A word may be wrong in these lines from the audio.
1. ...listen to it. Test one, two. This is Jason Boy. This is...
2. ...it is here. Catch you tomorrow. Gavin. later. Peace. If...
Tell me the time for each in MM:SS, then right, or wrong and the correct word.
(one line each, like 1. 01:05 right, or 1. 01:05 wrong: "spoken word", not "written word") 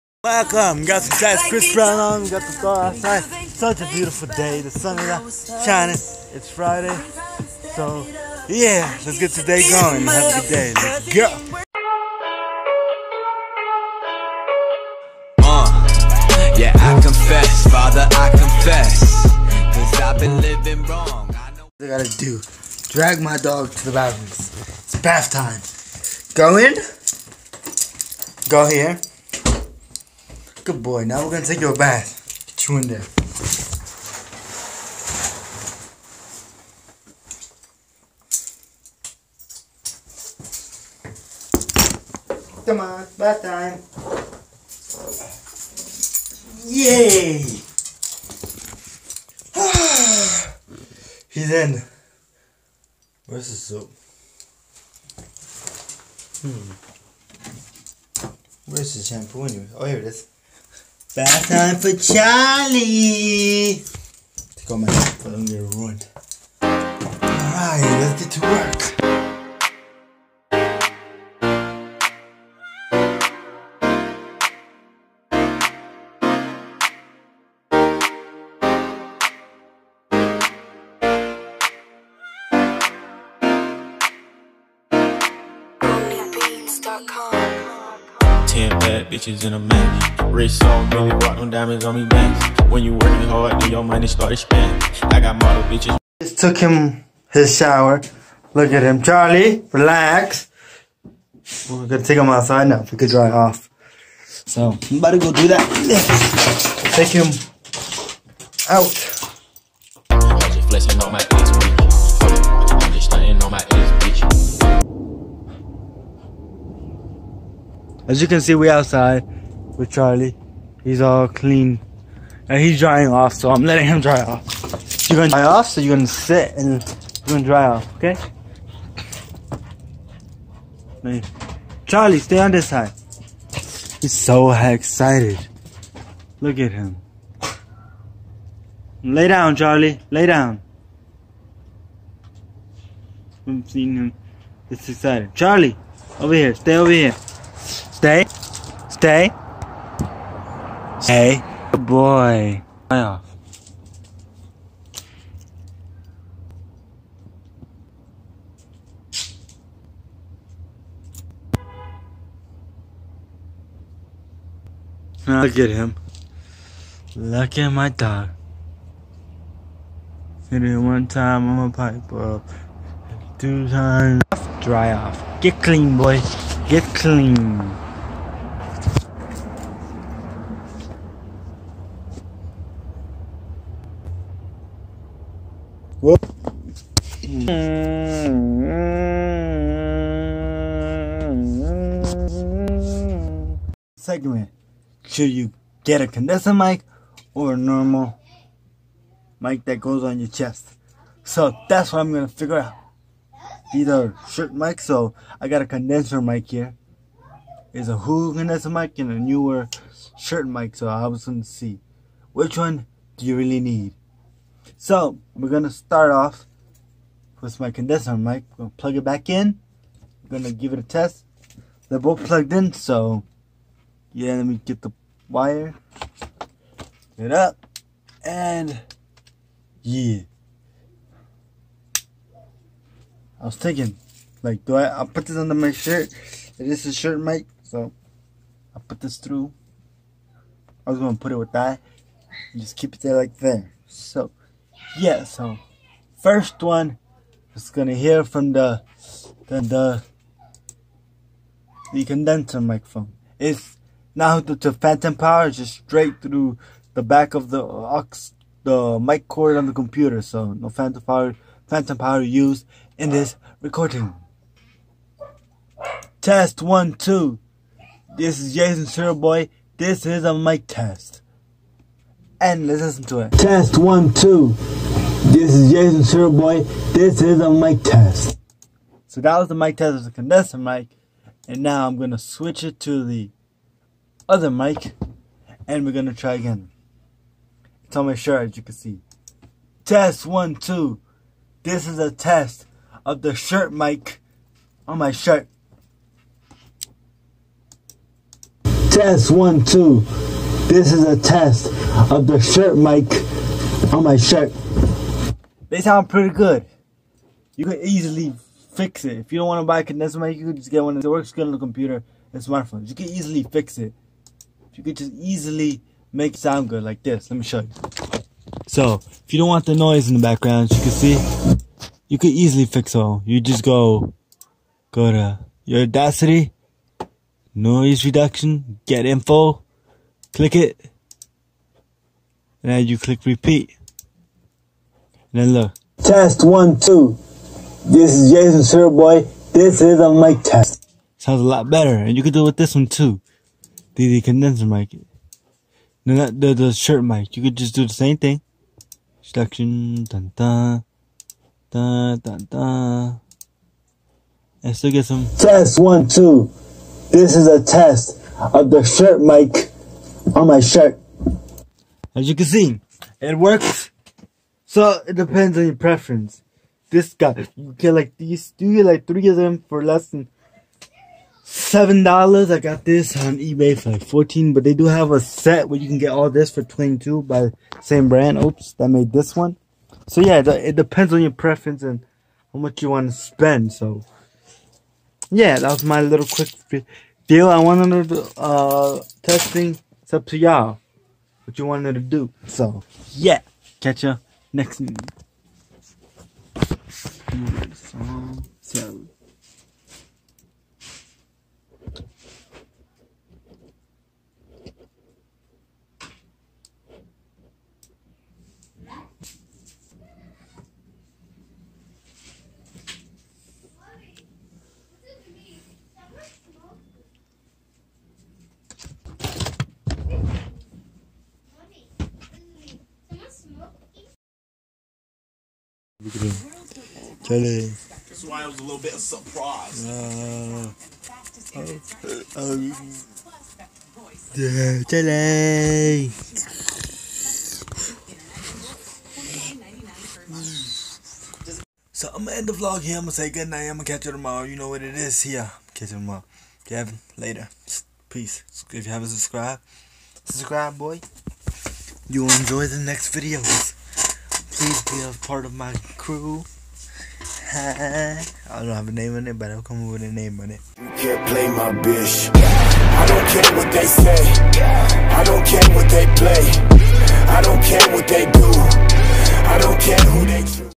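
1. 04:32 right
2. 07:24 right.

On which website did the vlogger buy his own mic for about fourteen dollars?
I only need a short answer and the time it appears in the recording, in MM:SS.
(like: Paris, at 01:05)
eBay, at 06:13.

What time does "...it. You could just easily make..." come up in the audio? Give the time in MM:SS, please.
05:13.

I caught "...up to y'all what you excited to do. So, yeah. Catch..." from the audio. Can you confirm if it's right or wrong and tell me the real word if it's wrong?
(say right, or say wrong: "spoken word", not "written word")
wrong: "wanted", not "excited".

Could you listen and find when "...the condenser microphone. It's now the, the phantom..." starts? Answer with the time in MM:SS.
04:11.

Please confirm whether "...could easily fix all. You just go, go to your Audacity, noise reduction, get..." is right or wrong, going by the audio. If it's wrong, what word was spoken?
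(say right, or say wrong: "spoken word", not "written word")
right.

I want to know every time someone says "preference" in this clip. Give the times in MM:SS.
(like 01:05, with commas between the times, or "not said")
06:05, 06:21.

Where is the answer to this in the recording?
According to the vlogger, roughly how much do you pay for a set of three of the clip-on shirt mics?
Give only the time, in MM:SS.
06:09.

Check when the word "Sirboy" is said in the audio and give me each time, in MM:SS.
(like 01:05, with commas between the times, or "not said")
04:28, 05:38.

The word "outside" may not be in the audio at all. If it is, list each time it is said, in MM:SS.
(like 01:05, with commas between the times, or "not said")
00:02, 01:42, 01:58.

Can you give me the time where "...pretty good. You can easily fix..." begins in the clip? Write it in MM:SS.
05:06.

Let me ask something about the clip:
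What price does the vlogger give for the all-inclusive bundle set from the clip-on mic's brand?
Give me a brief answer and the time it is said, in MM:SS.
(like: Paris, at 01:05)
$22, at 06:16.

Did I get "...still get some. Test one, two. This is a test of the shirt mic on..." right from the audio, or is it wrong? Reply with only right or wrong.
right.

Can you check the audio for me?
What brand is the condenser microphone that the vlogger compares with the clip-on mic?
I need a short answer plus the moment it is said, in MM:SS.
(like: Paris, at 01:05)
Hulu, at 03:27.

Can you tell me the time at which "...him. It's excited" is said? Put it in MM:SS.
02:23.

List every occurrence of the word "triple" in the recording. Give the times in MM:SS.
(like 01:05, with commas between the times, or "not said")
not said.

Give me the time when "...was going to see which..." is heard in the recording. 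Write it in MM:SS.
03:31.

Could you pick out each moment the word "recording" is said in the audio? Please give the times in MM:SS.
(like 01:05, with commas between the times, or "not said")
04:23.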